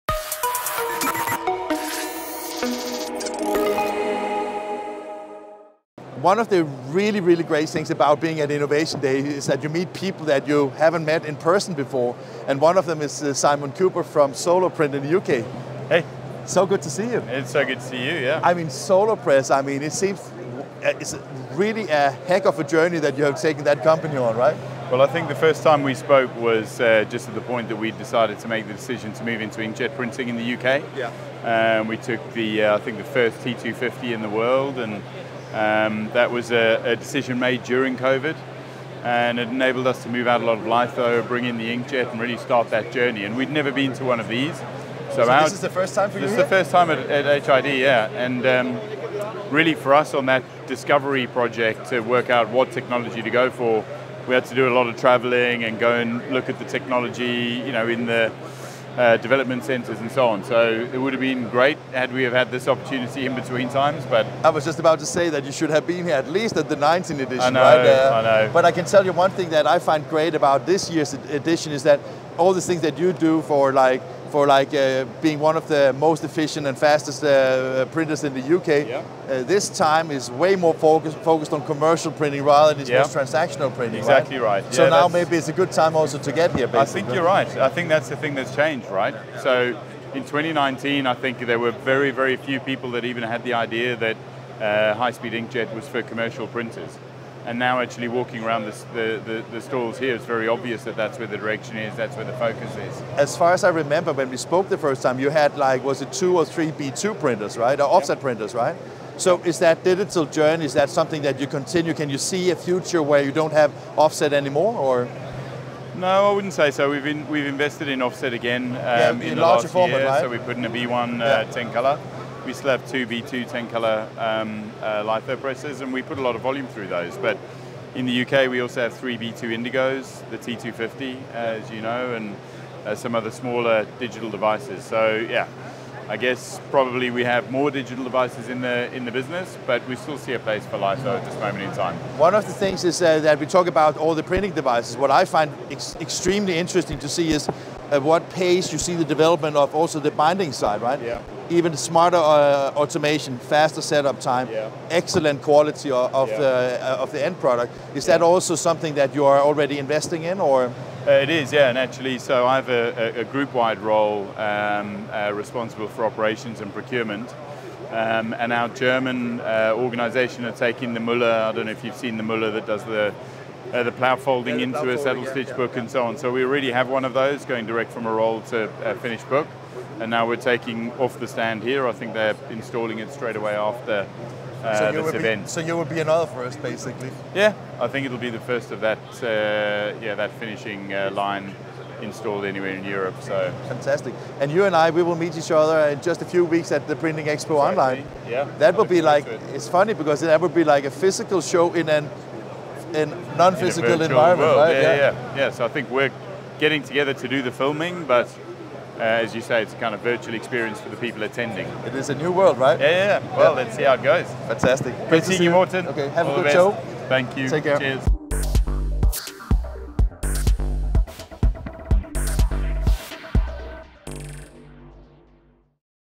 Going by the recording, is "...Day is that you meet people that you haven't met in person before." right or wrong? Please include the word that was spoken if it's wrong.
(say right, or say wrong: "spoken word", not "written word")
right.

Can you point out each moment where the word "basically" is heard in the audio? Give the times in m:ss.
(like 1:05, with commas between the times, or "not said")
1:26, 3:06.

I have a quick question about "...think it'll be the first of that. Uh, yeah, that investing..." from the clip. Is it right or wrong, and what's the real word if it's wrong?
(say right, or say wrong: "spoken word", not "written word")
wrong: "finishing", not "investing".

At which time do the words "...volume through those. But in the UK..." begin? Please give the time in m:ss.
2:06.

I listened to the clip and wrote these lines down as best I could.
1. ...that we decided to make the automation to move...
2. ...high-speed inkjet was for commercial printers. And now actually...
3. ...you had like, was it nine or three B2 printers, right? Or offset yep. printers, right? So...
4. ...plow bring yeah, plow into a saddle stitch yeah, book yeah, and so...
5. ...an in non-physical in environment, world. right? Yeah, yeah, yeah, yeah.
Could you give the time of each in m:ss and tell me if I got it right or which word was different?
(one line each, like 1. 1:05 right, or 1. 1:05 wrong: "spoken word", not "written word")
1. 0:27 wrong: "decision", not "automation"
2. 1:34 right
3. 1:45 wrong: "two", not "nine"
4. 2:53 wrong: "folding", not "bring"
5. 3:21 right.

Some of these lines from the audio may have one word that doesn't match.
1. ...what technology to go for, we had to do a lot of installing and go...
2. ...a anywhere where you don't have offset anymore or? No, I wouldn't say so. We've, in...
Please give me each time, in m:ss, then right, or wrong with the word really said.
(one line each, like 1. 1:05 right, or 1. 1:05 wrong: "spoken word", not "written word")
1. 0:52 wrong: "traveling", not "installing"
2. 1:52 wrong: "future", not "anywhere".